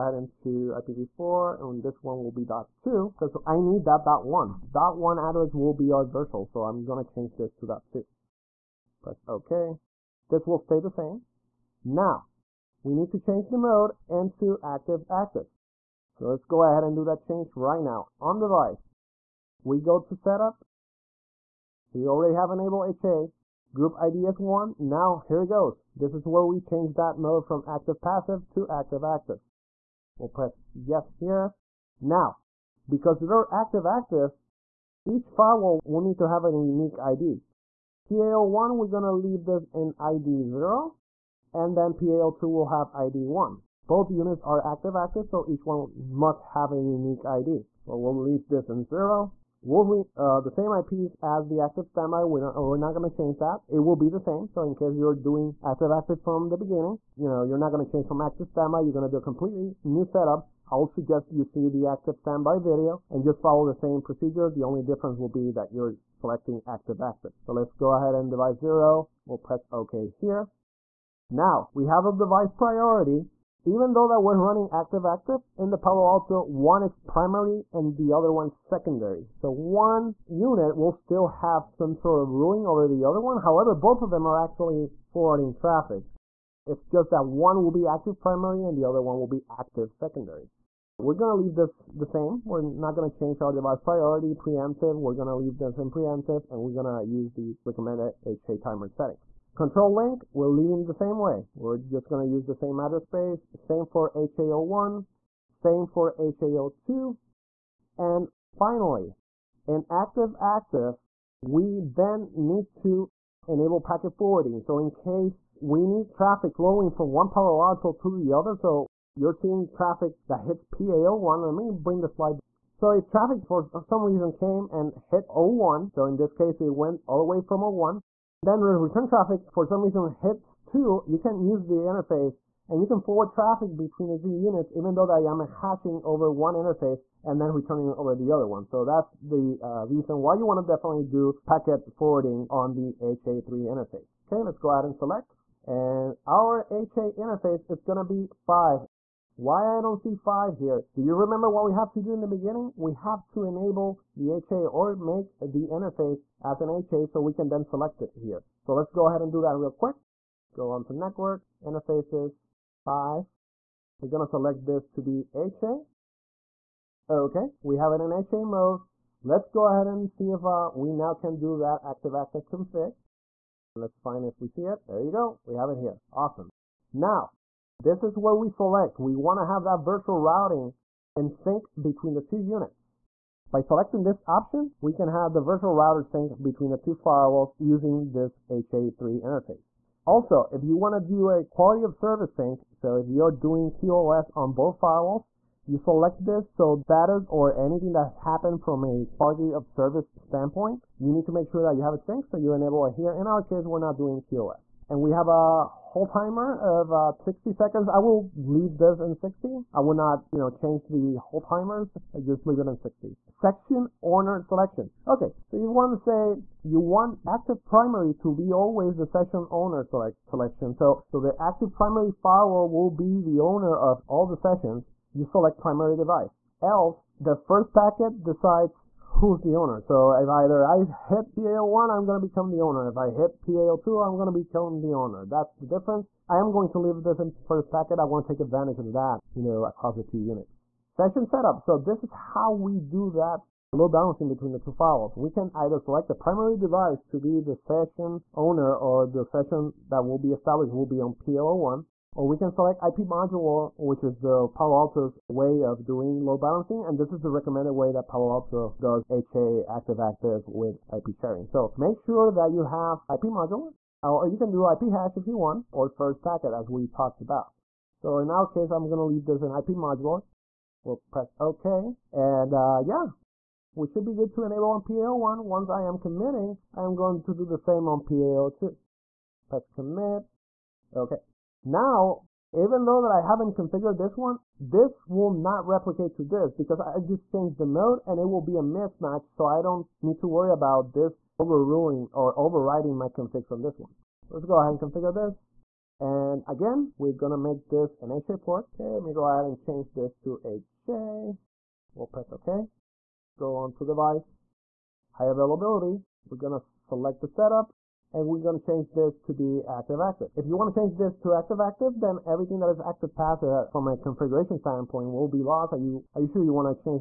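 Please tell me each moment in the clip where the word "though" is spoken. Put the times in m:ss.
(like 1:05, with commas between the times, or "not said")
1:13, 2:14, 4:42.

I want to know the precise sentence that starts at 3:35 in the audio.
Okay, so you want to say you want active primary to be always the session owner select selection.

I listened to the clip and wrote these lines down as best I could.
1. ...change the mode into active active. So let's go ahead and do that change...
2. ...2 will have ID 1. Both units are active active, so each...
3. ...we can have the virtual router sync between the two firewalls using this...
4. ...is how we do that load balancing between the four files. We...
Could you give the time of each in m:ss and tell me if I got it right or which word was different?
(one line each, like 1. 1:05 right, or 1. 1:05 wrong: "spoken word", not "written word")
1. 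0:13 right
2. 0:42 right
3. 3:04 right
4. 4:02 wrong: "two", not "four".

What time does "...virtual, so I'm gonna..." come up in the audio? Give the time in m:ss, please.
0:06.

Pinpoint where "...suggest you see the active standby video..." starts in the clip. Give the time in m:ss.
1:00.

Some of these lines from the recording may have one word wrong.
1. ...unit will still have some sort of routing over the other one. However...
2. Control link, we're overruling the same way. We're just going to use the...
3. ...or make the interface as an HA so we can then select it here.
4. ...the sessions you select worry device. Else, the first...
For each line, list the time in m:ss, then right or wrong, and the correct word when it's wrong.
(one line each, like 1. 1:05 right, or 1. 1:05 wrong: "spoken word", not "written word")
1. 1:20 wrong: "ruling", not "routing"
2. 1:39 wrong: "leaving", not "overruling"
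3. 2:34 right
4. 3:44 wrong: "primary", not "worry".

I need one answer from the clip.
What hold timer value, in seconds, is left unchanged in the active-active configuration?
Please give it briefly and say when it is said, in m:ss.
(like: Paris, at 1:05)
60, at 3:27.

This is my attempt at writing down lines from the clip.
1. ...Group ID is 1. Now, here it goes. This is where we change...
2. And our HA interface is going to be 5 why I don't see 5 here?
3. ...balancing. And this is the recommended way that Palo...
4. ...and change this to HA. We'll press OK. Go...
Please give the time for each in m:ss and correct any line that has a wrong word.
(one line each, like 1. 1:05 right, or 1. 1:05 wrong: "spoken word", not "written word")
1. 0:23 right
2. 2:25 right
3. 4:16 right
4. 4:59 right.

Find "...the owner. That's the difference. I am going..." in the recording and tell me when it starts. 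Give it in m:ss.
3:54.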